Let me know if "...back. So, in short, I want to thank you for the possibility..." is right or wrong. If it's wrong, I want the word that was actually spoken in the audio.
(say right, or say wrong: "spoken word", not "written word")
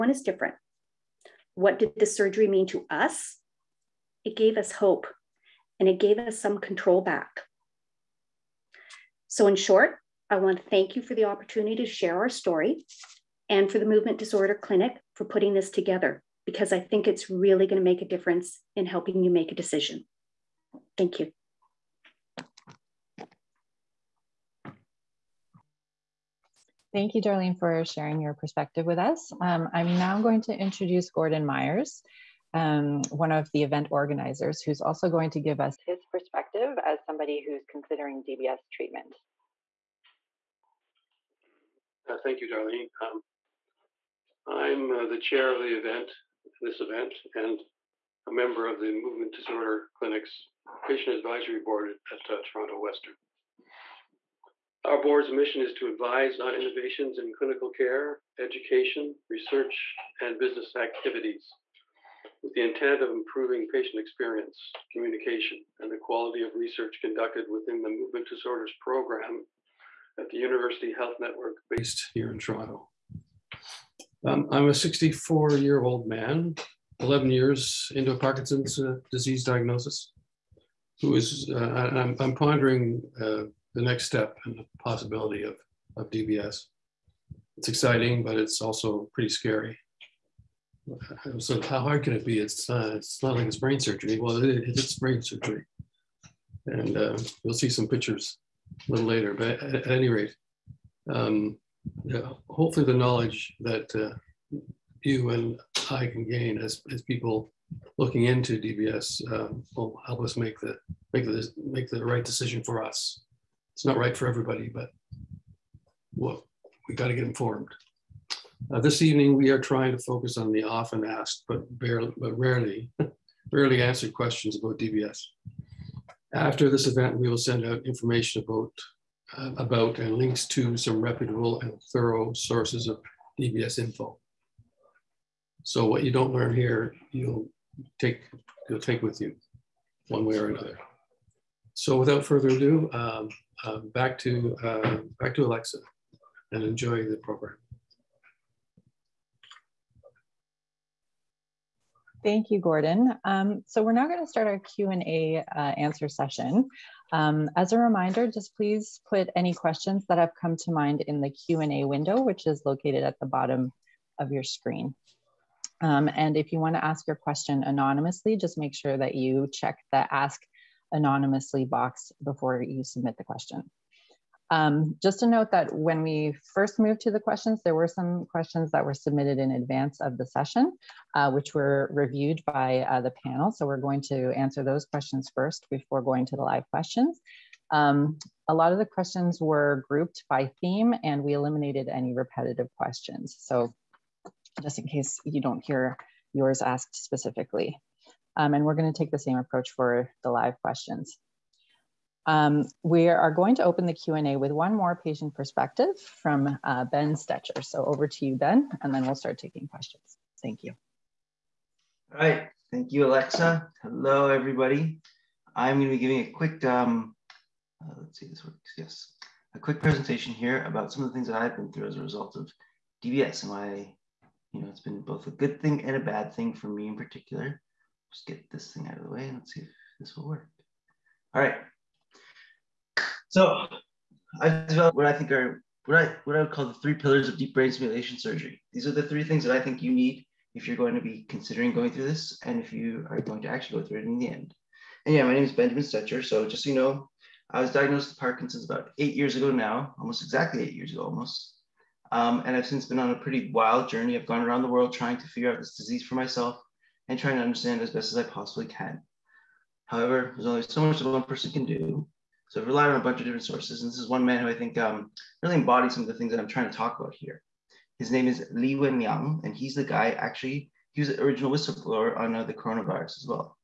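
wrong: "opportunity", not "possibility".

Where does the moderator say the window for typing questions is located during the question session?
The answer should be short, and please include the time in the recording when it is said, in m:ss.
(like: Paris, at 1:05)
Bottom of your screen, at 2:43.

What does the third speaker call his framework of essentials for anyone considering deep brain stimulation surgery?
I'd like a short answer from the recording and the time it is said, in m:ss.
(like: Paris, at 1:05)
The three pillars, at 3:56.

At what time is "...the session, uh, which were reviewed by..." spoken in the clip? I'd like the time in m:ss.
3:00.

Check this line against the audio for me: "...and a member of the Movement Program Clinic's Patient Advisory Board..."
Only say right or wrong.
wrong.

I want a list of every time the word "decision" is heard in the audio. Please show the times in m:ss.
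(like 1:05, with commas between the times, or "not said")
0:19, 1:52.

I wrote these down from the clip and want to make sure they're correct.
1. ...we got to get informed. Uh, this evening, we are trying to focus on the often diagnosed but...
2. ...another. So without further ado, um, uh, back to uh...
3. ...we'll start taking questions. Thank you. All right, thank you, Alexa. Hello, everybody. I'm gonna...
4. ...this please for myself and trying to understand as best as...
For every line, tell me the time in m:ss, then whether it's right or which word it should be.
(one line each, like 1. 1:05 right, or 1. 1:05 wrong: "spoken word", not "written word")
1. 1:56 wrong: "asked", not "diagnosed"
2. 2:20 right
3. 3:29 right
4. 4:15 wrong: "disease", not "please".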